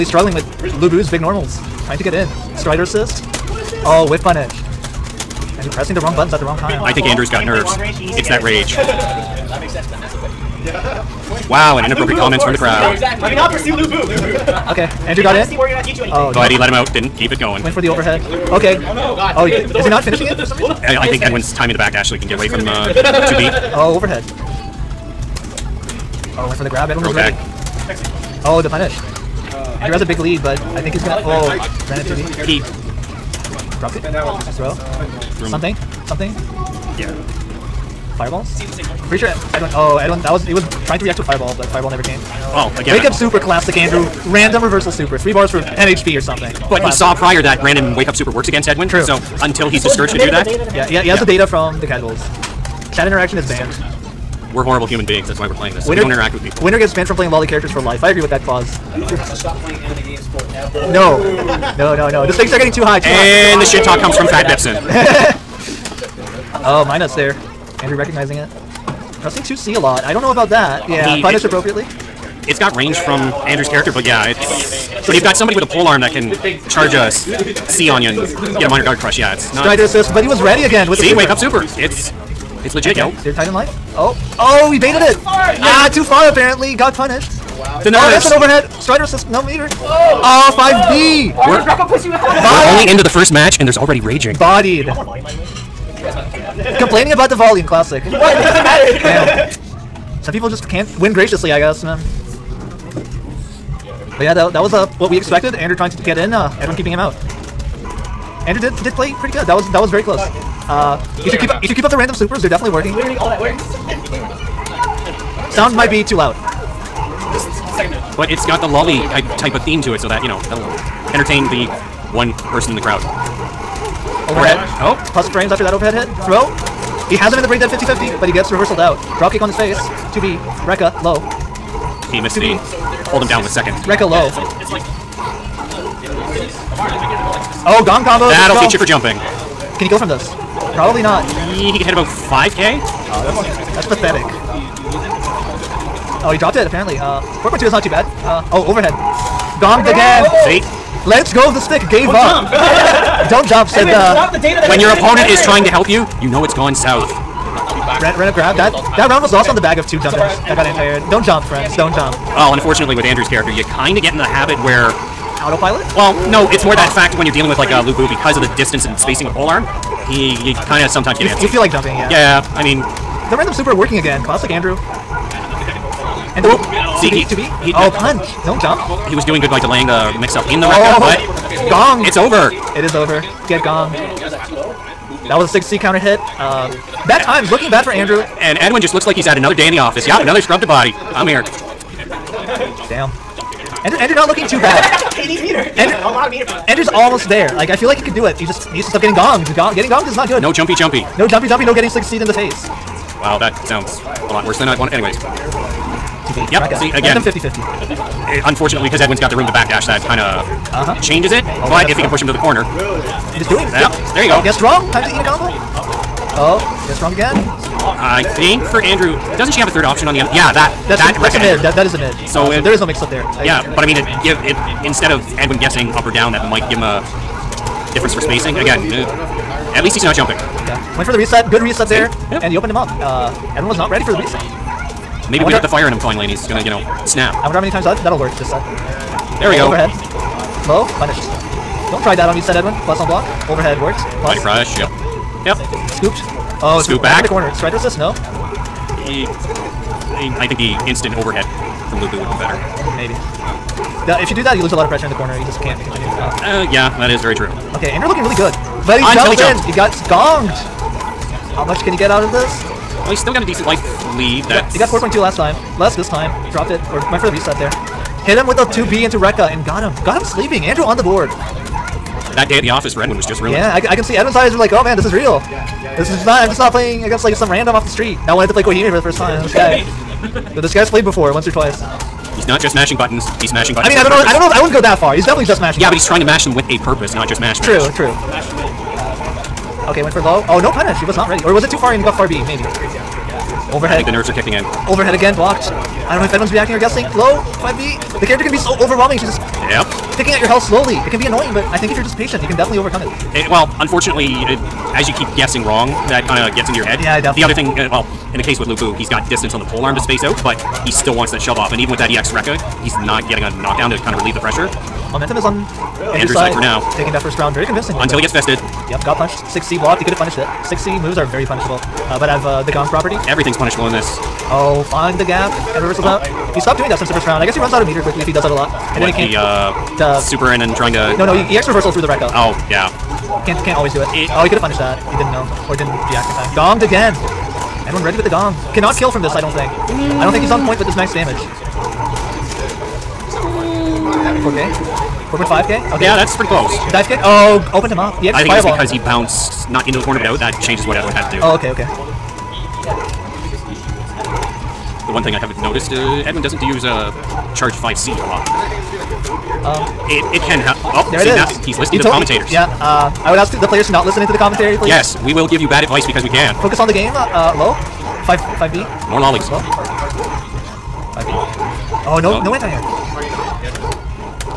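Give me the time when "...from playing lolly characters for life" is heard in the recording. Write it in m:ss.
0:57.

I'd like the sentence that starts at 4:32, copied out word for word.
That day at the office for Edwin was just ruined.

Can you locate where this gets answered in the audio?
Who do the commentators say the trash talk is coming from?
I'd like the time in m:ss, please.
1:04.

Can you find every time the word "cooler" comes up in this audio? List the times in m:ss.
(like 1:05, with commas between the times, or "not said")
not said.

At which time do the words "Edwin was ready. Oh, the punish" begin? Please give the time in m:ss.
0:26.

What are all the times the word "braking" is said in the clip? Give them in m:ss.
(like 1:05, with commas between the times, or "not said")
not said.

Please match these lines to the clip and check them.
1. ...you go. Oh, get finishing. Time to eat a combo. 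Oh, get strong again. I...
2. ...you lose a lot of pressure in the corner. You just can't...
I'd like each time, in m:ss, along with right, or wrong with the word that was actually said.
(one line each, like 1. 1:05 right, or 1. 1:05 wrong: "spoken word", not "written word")
1. 3:34 wrong: "strong", not "finishing"
2. 4:14 right.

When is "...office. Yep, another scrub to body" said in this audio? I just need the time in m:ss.
3:09.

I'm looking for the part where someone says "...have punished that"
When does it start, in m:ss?
5:34.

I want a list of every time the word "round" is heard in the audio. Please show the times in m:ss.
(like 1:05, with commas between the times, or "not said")
2:39, 5:17, 5:27.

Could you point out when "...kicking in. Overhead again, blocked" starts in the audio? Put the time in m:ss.
4:54.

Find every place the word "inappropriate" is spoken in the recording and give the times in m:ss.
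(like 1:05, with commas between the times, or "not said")
0:11.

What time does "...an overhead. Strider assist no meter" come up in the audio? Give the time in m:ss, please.
1:28.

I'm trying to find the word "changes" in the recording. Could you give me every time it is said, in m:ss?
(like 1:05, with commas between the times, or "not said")
3:31, 5:50.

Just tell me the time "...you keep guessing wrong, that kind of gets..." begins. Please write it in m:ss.
5:05.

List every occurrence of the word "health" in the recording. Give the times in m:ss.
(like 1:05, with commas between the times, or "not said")
5:00.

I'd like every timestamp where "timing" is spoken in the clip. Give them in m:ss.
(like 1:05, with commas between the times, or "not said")
0:21.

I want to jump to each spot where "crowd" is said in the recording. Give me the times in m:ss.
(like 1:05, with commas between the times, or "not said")
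0:12, 2:02.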